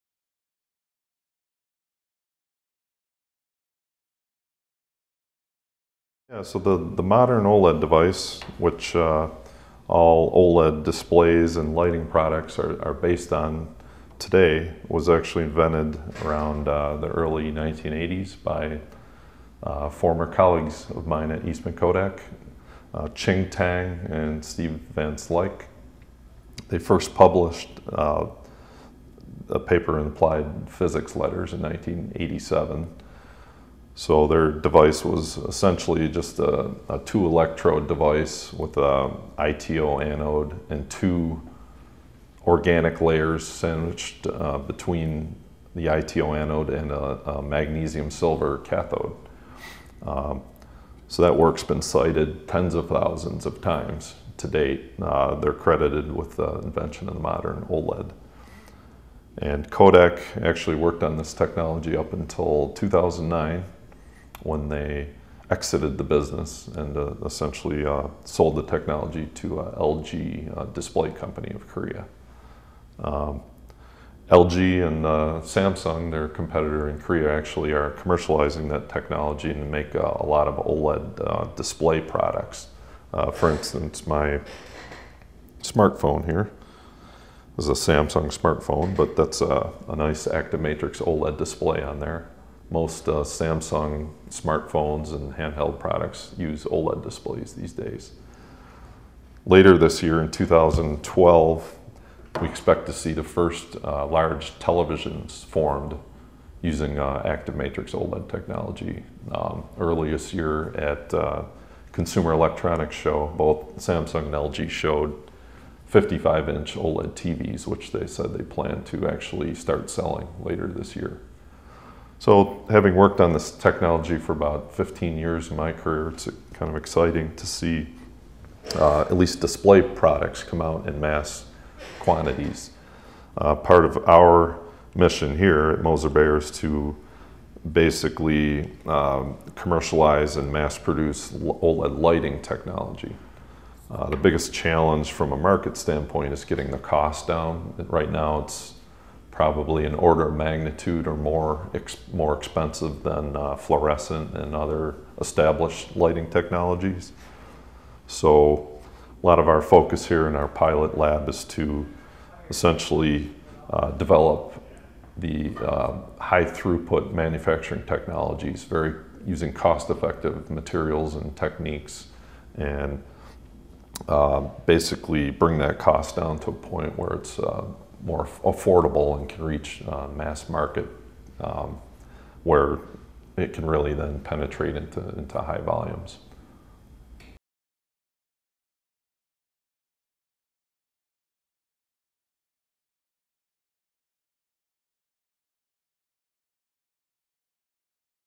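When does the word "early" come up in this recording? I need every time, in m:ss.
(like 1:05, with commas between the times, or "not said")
0:17, 1:49.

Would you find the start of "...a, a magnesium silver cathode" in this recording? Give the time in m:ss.
0:46.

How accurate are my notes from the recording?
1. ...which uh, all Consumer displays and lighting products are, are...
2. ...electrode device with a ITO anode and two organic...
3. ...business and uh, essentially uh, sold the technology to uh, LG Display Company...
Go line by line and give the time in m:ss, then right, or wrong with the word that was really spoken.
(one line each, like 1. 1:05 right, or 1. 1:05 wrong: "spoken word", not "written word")
1. 0:08 wrong: "OLED", not "Consumer"
2. 0:37 right
3. 1:06 right.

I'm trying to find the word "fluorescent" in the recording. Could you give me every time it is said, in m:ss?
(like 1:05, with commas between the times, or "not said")
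2:33.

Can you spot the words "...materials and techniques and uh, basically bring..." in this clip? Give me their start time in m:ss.
2:50.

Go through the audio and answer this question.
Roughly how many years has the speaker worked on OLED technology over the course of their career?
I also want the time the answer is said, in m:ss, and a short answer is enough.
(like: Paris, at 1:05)
15 years, at 2:04.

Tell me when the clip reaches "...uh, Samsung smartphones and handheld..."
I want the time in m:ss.
1:33.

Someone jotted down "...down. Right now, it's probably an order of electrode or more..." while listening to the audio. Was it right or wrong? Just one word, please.
wrong.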